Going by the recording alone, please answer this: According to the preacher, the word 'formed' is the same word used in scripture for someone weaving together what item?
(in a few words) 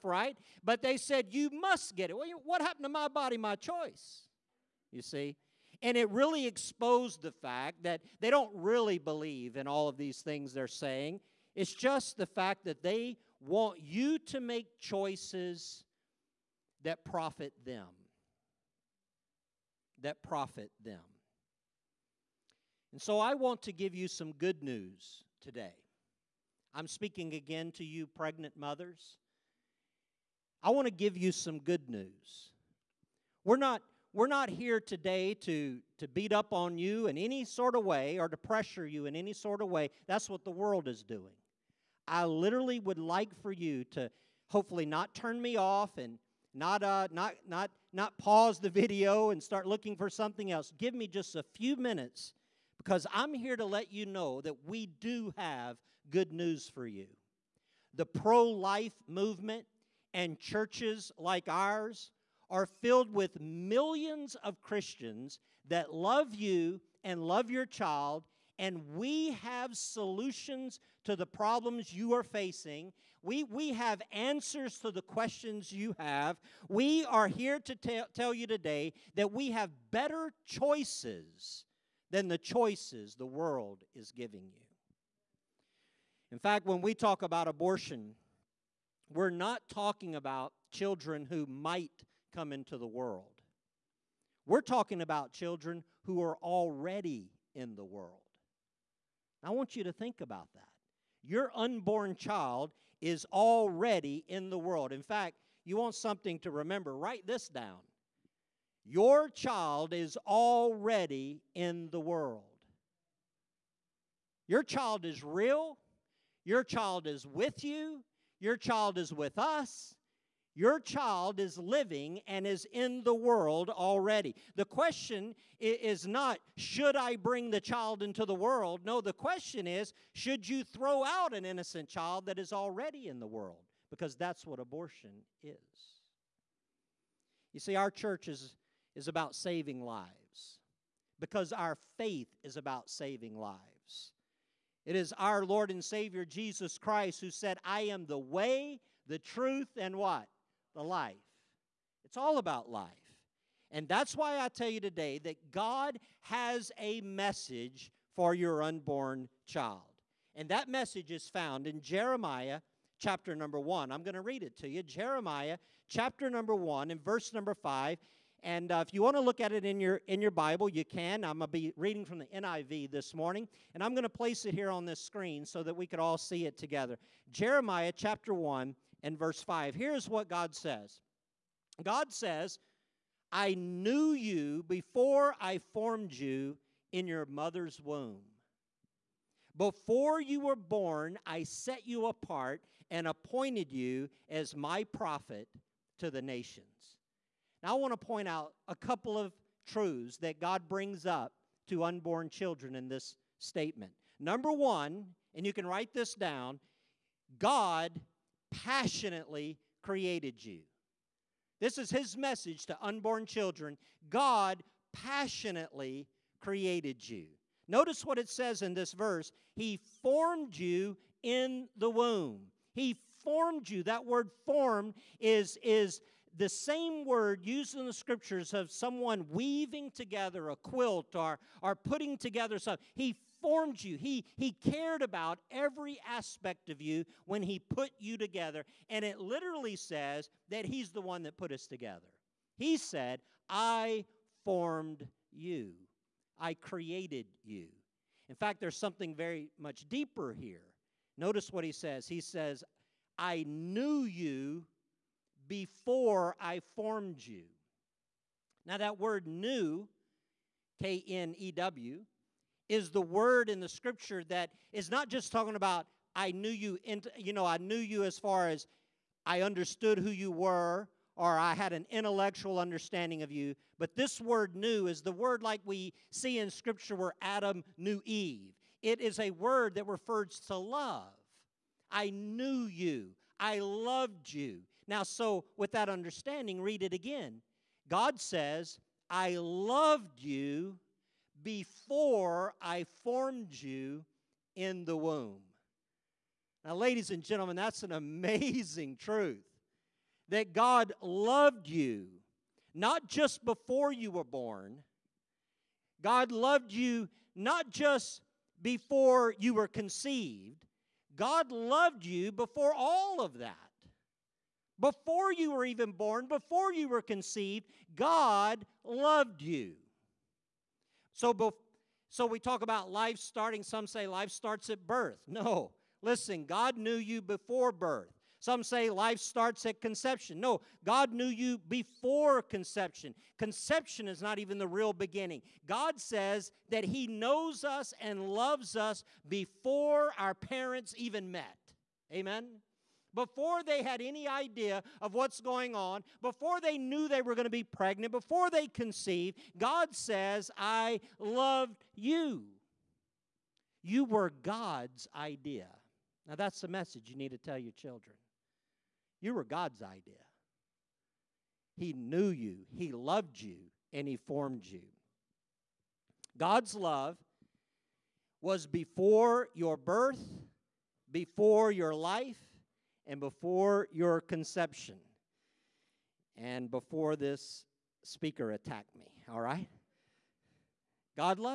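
a quilt.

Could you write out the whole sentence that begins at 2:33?
And that's why I tell you today that God has a message for your unborn child.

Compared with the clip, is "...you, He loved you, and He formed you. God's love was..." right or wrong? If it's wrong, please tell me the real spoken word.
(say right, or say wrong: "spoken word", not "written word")
right.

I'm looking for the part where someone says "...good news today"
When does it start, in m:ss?
0:24.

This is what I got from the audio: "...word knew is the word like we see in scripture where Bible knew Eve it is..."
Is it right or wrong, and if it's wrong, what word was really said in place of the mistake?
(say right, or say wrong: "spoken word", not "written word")
wrong: "Adam", not "Bible".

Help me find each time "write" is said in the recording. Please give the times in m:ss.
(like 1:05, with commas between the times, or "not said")
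1:46, 3:25.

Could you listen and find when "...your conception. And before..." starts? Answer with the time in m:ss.
6:13.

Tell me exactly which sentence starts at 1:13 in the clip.
We, we have answers to the questions you have.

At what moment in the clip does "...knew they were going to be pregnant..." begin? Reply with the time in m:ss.
5:46.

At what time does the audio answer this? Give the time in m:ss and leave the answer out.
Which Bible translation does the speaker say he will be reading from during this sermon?
2:52.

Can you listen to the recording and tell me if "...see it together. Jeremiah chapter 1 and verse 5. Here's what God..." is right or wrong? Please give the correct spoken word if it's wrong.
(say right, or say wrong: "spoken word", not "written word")
right.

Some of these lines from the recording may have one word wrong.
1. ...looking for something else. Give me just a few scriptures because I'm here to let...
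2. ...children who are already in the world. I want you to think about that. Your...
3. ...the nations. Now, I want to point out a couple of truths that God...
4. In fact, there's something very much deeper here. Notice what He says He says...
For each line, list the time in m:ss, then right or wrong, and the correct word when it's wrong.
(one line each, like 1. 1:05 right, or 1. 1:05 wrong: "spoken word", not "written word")
1. 0:49 wrong: "minutes", not "scriptures"
2. 1:35 right
3. 3:16 right
4. 4:08 right.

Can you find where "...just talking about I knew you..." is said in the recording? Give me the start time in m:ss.
4:25.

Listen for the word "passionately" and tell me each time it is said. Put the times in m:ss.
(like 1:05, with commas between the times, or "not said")
3:28, 3:34.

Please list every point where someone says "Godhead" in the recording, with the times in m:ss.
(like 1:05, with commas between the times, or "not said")
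not said.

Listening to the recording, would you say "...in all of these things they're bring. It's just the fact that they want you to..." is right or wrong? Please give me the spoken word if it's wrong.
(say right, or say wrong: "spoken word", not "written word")
wrong: "saying", not "bring".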